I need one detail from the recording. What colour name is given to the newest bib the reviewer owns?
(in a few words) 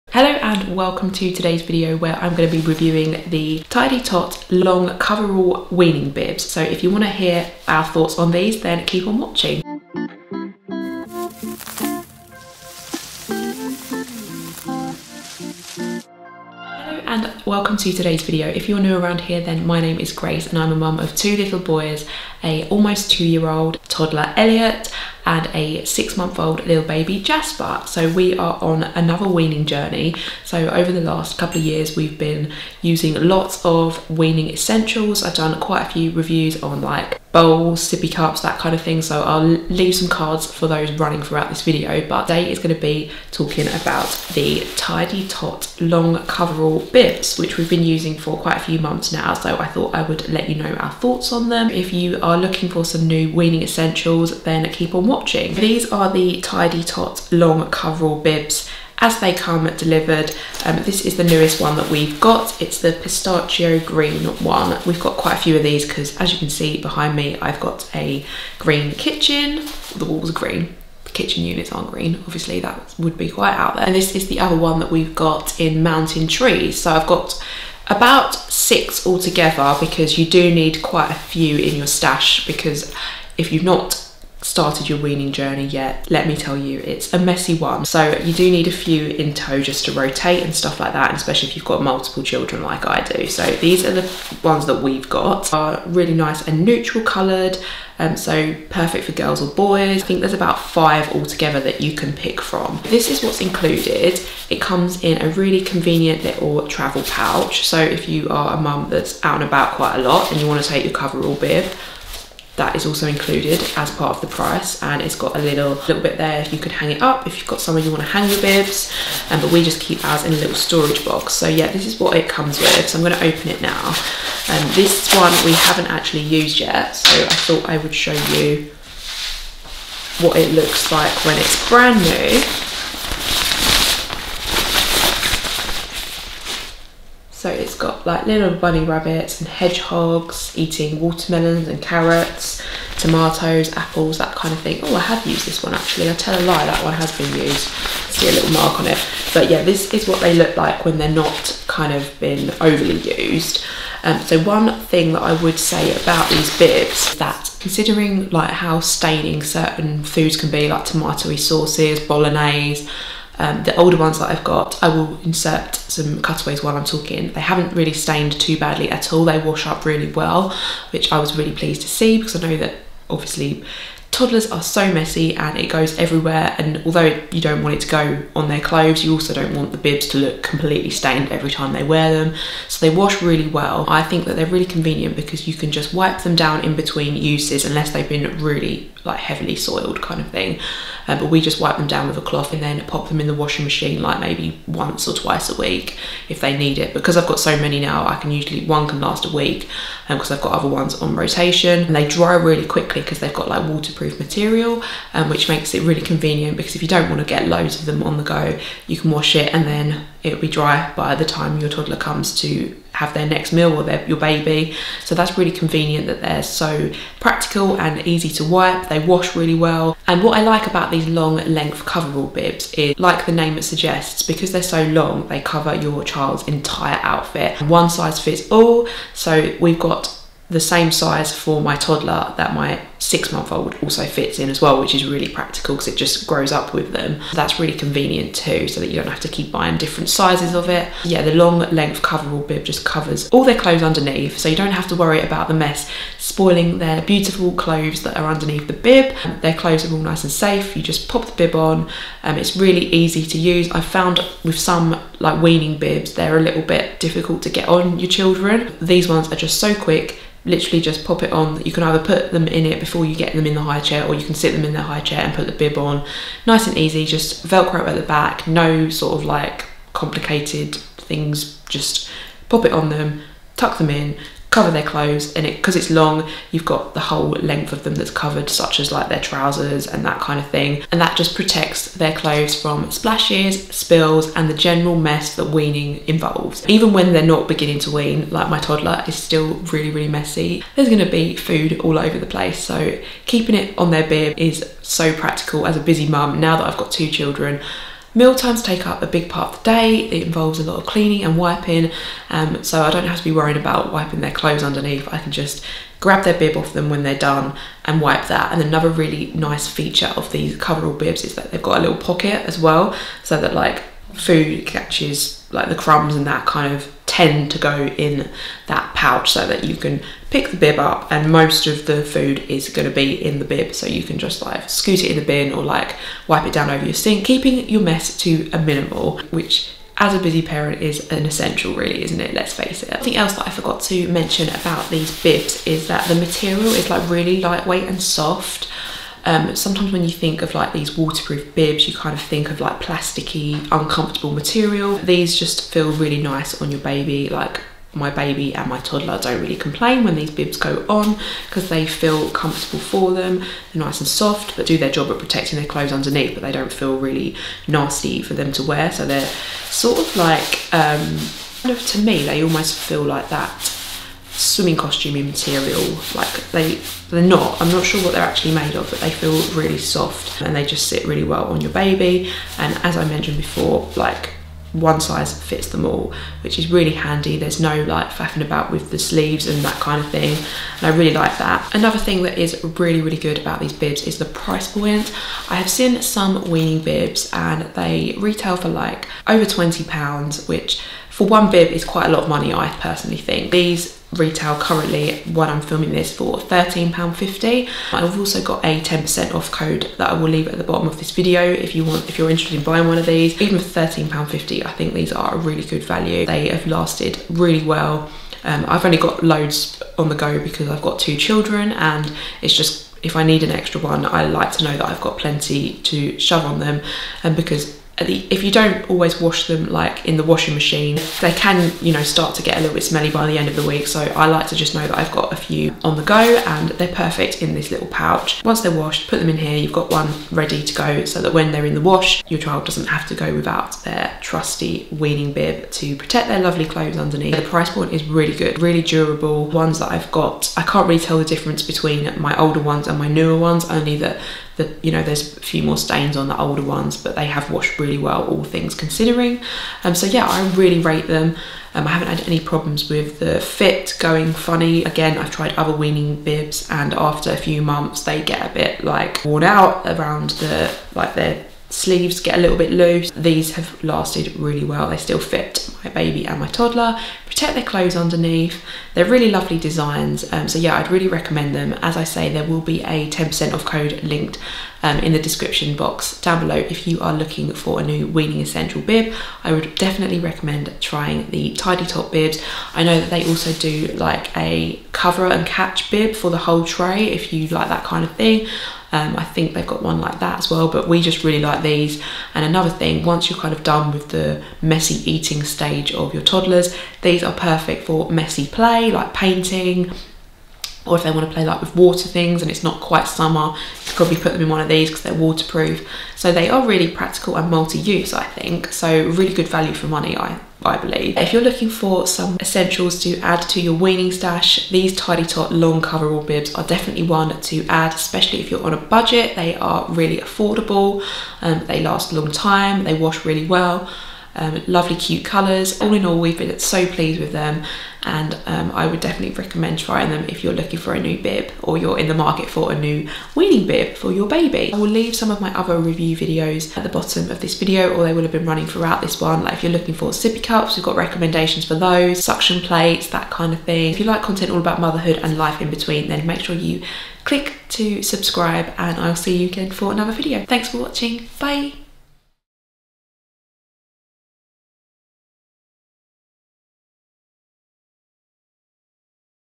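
Pistachio green.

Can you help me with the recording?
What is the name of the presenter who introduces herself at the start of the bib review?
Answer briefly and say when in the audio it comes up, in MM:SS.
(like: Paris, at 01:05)
Grace, at 00:20.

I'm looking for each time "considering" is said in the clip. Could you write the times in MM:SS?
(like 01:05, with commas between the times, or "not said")
02:37, 07:28.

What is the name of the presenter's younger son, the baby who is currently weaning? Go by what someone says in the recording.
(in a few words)
Jasper.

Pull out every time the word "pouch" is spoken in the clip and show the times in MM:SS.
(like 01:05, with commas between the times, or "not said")
01:47, 05:18, 07:07.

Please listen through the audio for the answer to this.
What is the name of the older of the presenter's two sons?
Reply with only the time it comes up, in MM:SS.
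00:24.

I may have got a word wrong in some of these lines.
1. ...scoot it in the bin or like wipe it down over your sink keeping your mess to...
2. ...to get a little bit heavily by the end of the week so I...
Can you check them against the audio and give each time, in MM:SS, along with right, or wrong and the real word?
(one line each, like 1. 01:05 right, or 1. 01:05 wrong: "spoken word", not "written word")
1. 05:24 right
2. 07:02 wrong: "smelly", not "heavily".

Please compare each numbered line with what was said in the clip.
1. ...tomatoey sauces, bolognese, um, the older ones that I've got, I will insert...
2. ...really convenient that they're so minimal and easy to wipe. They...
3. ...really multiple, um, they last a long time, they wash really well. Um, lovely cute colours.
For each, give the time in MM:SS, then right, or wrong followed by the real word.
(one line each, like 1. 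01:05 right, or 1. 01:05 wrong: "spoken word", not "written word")
1. 02:40 right
2. 03:35 wrong: "practical", not "minimal"
3. 08:39 wrong: "affordable", not "multiple".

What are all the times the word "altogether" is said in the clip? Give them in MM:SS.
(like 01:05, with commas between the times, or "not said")
01:19, 01:41.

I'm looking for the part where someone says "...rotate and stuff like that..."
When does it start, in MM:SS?
01:29.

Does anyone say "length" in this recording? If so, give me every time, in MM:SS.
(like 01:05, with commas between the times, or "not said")
03:41, 04:01, 04:37.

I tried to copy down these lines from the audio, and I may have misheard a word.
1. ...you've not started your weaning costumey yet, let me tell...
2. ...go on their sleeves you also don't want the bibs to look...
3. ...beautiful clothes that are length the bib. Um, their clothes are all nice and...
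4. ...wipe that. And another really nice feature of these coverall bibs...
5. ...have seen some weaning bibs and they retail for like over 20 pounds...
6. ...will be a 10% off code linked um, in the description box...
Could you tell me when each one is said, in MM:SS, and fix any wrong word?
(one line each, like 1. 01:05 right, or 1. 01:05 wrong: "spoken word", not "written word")
1. 01:23 wrong: "journey", not "costumey"
2. 02:57 wrong: "clothes", not "sleeves"
3. 04:07 wrong: "underneath", not "length"
4. 05:08 right
5. 06:25 right
6. 07:52 right.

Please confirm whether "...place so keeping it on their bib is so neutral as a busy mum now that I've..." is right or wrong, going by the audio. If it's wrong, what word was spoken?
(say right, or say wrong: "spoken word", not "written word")
wrong: "practical", not "neutral".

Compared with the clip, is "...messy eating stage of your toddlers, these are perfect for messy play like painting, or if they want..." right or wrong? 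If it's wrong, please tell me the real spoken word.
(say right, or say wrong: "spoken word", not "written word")
right.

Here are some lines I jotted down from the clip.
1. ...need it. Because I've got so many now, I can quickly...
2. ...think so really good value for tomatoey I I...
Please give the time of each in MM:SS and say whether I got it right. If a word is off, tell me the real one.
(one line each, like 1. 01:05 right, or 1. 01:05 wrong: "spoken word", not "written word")
1. 03:16 wrong: "usually", not "quickly"
2. 08:28 wrong: "money", not "tomatoey".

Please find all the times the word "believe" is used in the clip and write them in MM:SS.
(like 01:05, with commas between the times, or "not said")
08:30.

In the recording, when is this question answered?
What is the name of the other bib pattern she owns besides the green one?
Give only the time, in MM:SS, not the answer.
01:15.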